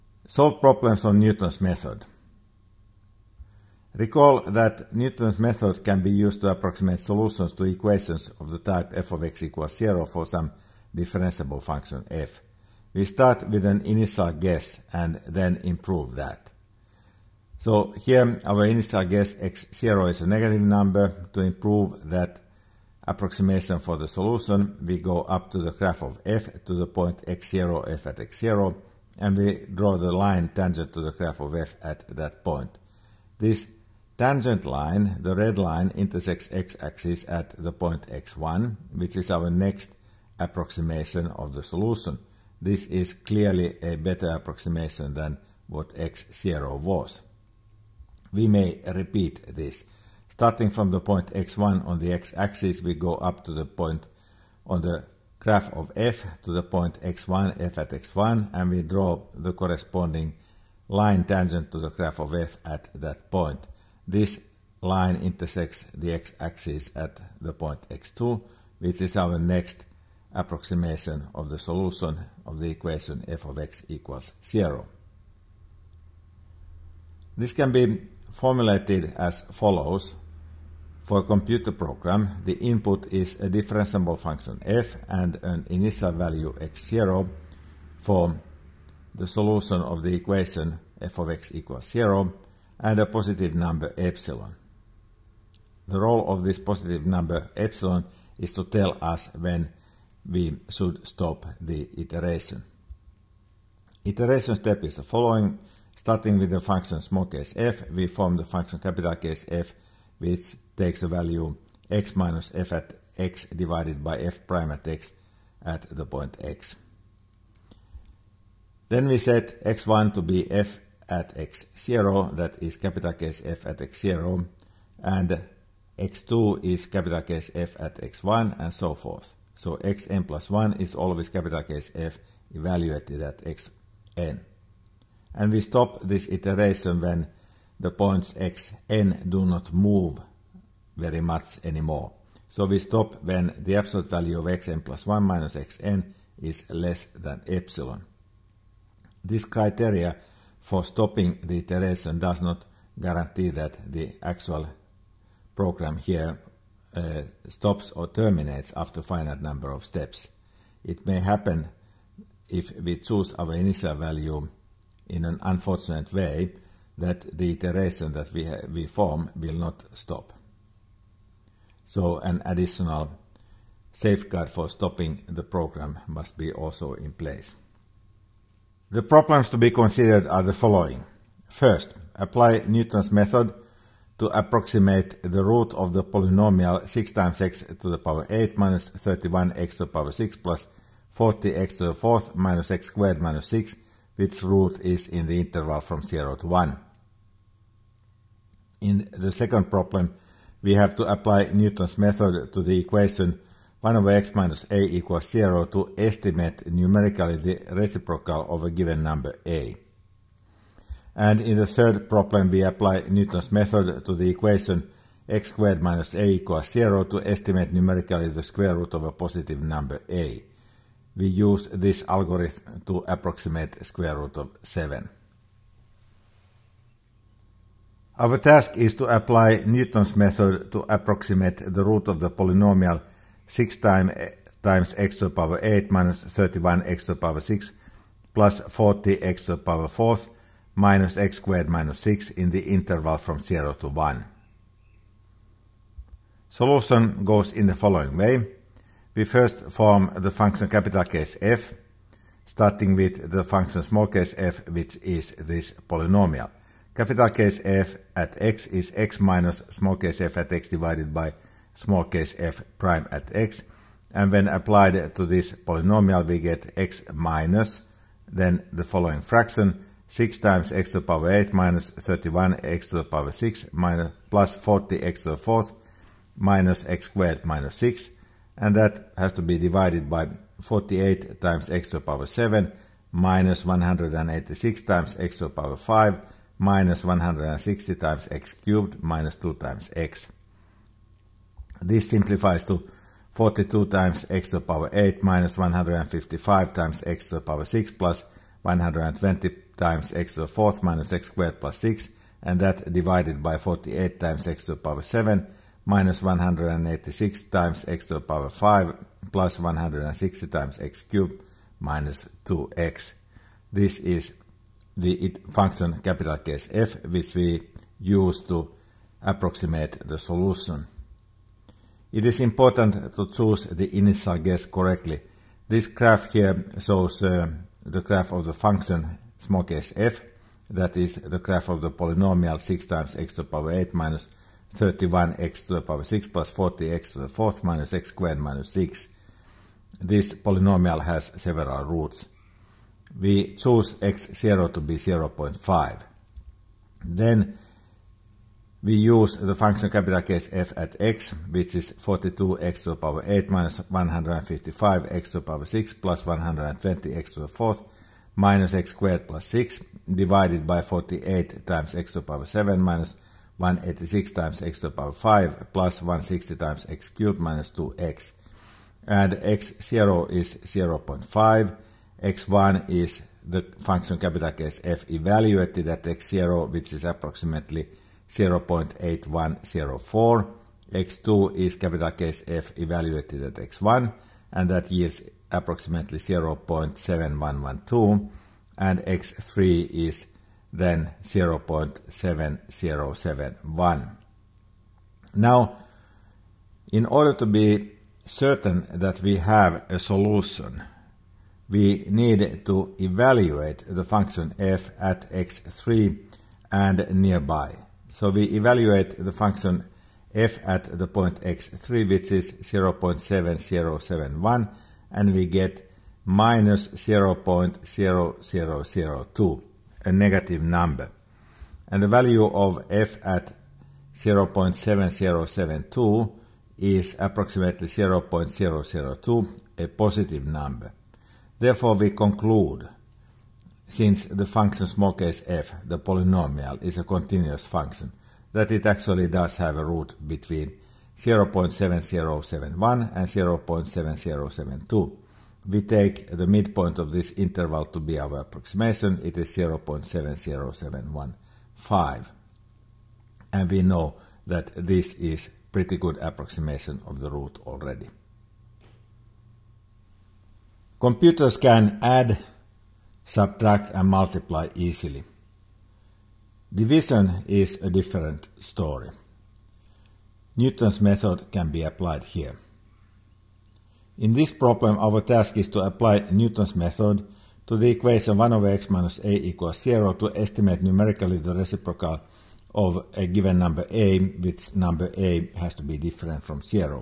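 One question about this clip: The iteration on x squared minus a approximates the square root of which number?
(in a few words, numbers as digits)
7.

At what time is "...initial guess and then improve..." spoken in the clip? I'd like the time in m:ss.
0:13.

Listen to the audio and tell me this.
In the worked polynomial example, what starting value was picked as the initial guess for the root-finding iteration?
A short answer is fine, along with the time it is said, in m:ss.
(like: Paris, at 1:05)
0.5, at 5:43.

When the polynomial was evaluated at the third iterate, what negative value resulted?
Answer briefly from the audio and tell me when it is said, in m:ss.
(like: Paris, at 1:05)
-0.0002, at 6:56.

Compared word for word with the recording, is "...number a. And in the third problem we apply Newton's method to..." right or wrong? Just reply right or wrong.
right.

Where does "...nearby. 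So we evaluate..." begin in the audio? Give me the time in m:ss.
6:47.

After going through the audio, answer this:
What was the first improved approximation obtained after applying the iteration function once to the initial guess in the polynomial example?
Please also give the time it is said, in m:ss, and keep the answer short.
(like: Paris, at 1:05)
0.8104, at 6:18.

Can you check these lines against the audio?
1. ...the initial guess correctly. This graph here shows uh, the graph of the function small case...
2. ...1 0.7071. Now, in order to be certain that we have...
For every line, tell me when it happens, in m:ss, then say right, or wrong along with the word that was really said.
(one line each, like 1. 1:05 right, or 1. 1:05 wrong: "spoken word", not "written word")
1. 5:23 right
2. 6:31 wrong: "0", not "1".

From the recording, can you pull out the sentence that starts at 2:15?
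And we stop this iteration when the points xn do not move very much anymore.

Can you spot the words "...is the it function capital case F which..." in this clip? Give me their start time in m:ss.
5:13.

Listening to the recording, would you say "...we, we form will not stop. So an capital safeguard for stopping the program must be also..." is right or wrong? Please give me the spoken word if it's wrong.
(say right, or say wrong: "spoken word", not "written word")
wrong: "additional", not "capital".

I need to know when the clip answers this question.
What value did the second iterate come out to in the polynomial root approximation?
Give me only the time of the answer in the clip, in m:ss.
6:26.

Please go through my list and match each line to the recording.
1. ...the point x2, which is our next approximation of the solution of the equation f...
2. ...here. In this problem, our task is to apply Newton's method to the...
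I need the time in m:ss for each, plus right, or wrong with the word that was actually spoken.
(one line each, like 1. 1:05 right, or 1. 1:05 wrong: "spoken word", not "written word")
1. 1:07 right
2. 7:52 right.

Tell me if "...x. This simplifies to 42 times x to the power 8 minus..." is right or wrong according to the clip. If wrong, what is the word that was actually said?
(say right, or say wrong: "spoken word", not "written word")
right.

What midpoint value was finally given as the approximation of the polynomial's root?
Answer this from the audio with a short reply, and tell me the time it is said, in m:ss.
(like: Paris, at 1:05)
0.70715, at 7:29.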